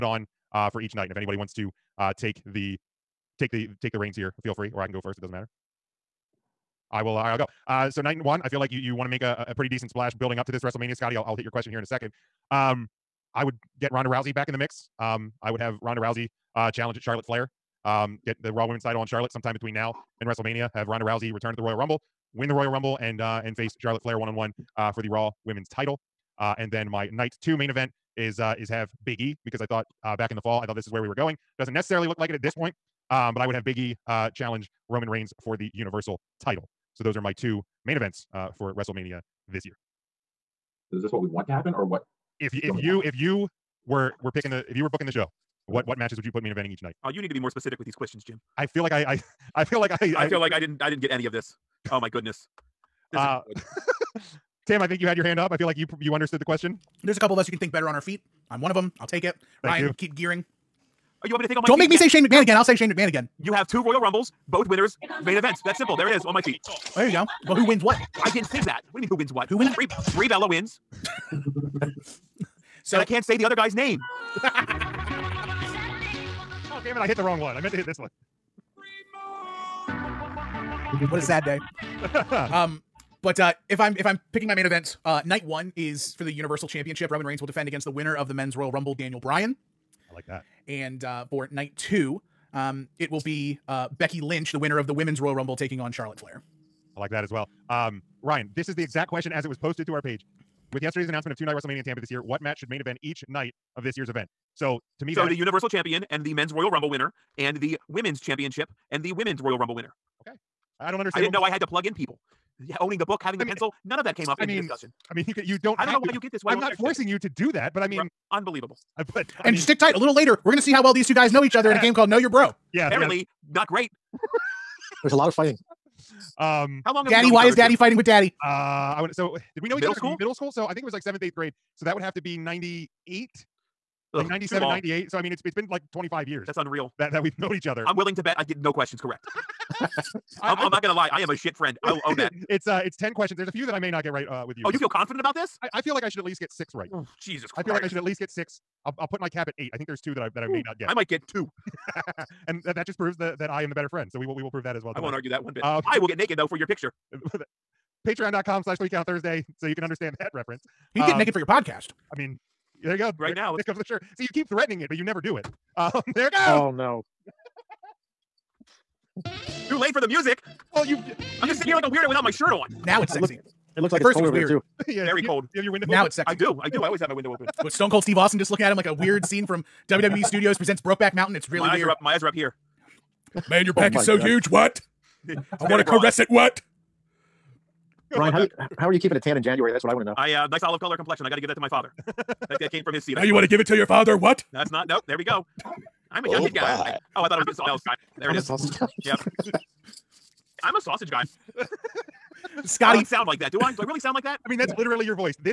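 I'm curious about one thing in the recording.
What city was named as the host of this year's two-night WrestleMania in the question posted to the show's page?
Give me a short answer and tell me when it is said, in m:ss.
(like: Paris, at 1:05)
Tampa, at 1:41.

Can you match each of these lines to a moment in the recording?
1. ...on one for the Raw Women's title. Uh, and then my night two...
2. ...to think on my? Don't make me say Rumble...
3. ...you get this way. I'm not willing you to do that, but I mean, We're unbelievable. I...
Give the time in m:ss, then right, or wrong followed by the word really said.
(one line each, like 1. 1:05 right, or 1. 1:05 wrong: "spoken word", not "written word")
1. 0:24 right
2. 1:01 wrong: "Shane", not "Rumble"
3. 1:56 wrong: "forcing", not "willing".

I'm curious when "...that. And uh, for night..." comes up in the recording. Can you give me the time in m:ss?
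1:30.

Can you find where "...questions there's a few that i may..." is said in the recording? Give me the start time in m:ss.
2:23.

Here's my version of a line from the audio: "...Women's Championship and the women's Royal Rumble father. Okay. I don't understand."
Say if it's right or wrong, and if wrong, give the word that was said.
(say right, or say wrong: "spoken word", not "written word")
wrong: "winner", not "father".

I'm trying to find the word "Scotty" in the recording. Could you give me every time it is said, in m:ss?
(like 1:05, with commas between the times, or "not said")
0:10, 3:22.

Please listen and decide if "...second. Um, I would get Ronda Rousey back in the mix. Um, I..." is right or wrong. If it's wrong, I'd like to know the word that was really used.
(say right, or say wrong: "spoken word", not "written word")
right.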